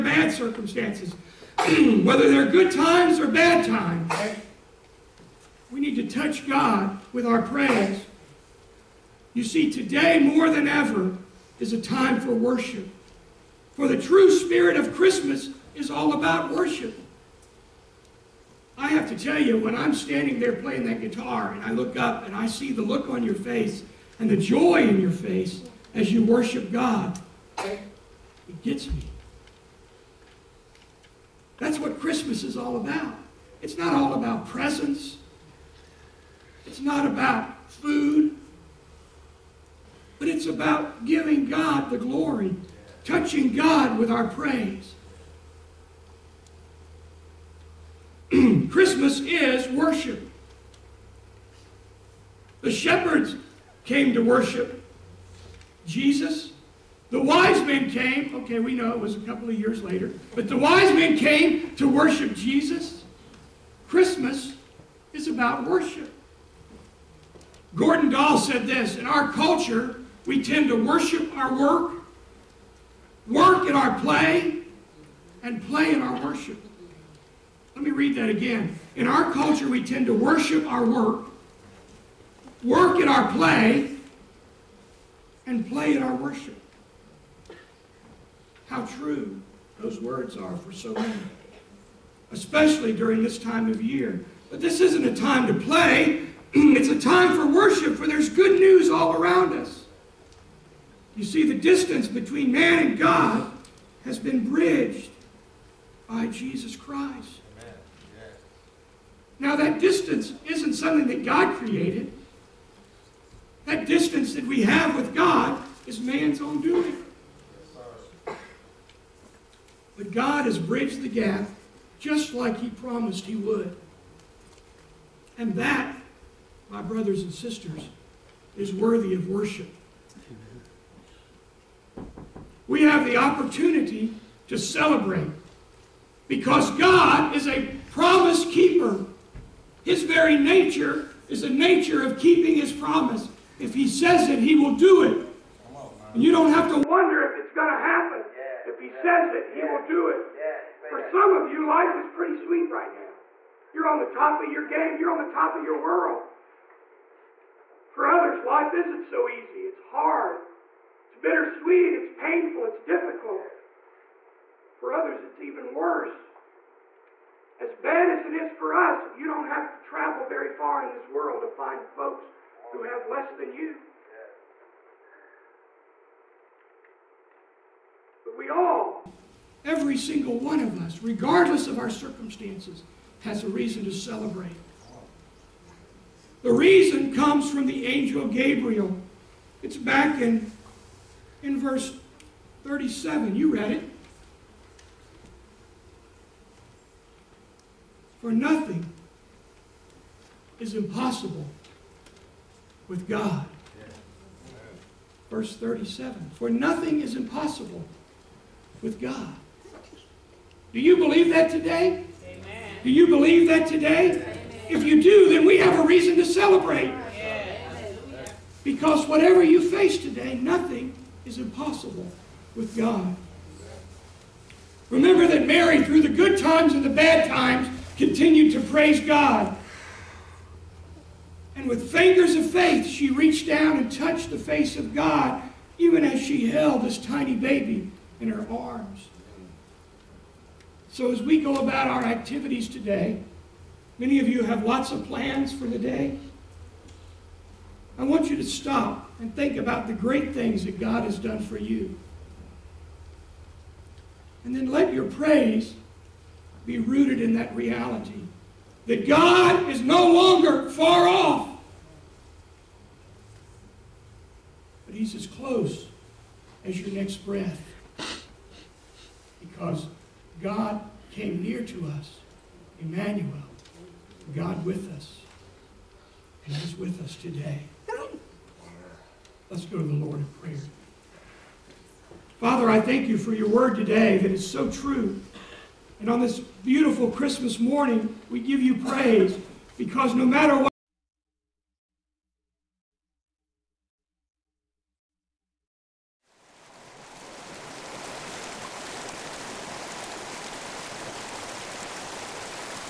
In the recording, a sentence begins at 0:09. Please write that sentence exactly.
You see, today more than ever is a time for worship.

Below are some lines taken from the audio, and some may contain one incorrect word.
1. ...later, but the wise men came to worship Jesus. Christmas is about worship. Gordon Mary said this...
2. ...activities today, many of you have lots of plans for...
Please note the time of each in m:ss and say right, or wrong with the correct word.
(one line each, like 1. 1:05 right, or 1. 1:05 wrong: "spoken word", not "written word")
1. 0:59 wrong: "Dahl", not "Mary"
2. 4:02 right.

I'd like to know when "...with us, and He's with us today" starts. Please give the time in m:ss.
4:34.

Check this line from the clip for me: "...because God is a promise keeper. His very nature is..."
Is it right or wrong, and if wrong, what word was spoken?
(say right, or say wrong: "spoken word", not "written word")
right.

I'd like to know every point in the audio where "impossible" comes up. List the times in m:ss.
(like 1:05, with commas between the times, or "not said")
3:20, 3:27, 3:41.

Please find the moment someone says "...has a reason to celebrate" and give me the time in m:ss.
3:03.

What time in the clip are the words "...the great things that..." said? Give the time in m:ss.
4:09.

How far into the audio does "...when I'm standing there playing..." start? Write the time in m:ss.
0:19.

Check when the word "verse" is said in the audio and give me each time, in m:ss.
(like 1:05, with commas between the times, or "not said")
3:11, 3:25.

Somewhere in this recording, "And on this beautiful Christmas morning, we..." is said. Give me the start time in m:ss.
4:45.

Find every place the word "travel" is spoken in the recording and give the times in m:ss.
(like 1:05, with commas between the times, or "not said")
2:49.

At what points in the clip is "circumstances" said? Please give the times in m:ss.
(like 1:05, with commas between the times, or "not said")
0:00, 3:01.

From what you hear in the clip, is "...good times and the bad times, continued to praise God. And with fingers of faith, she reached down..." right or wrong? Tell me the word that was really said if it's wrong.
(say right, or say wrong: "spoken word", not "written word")
right.